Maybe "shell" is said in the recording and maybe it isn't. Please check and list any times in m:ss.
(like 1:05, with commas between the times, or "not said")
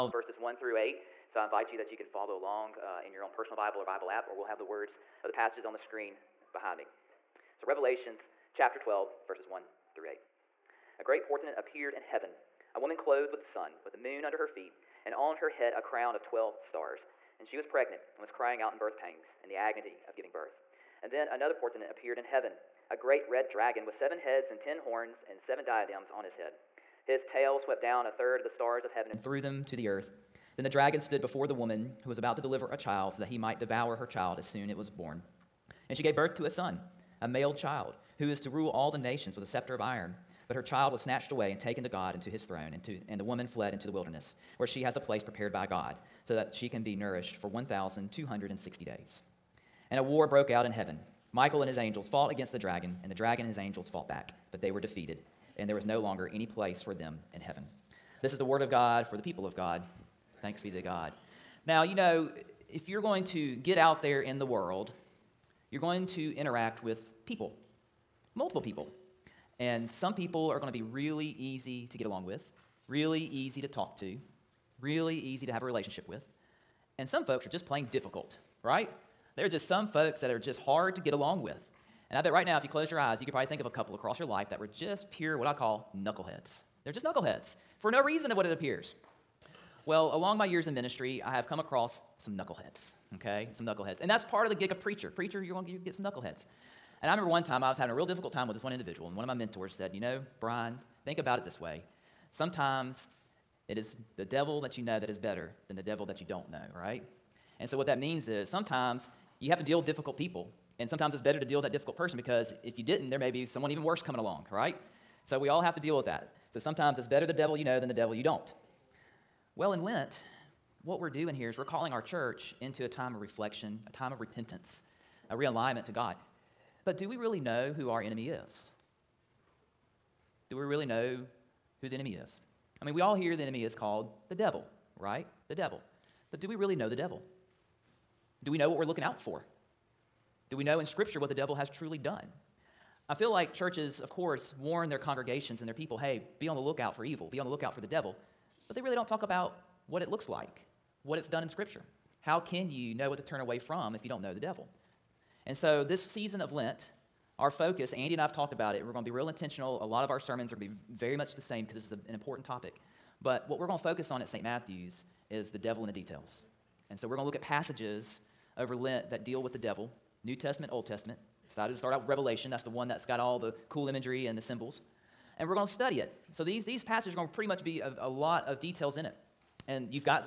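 not said.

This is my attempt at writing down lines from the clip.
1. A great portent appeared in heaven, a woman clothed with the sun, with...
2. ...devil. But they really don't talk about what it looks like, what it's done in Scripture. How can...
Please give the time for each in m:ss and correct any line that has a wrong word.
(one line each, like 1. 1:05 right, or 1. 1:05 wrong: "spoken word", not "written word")
1. 0:10 right
2. 2:27 right.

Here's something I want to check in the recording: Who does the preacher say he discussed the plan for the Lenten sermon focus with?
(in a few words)
Andy.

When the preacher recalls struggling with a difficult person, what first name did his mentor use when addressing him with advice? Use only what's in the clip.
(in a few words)
Brian.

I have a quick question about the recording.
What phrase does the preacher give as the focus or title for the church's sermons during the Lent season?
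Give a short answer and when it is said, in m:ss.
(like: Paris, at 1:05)
the devil in the details, at 2:45.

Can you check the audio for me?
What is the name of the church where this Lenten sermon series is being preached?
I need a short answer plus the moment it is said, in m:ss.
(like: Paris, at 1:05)
St. Matthew's, at 2:44.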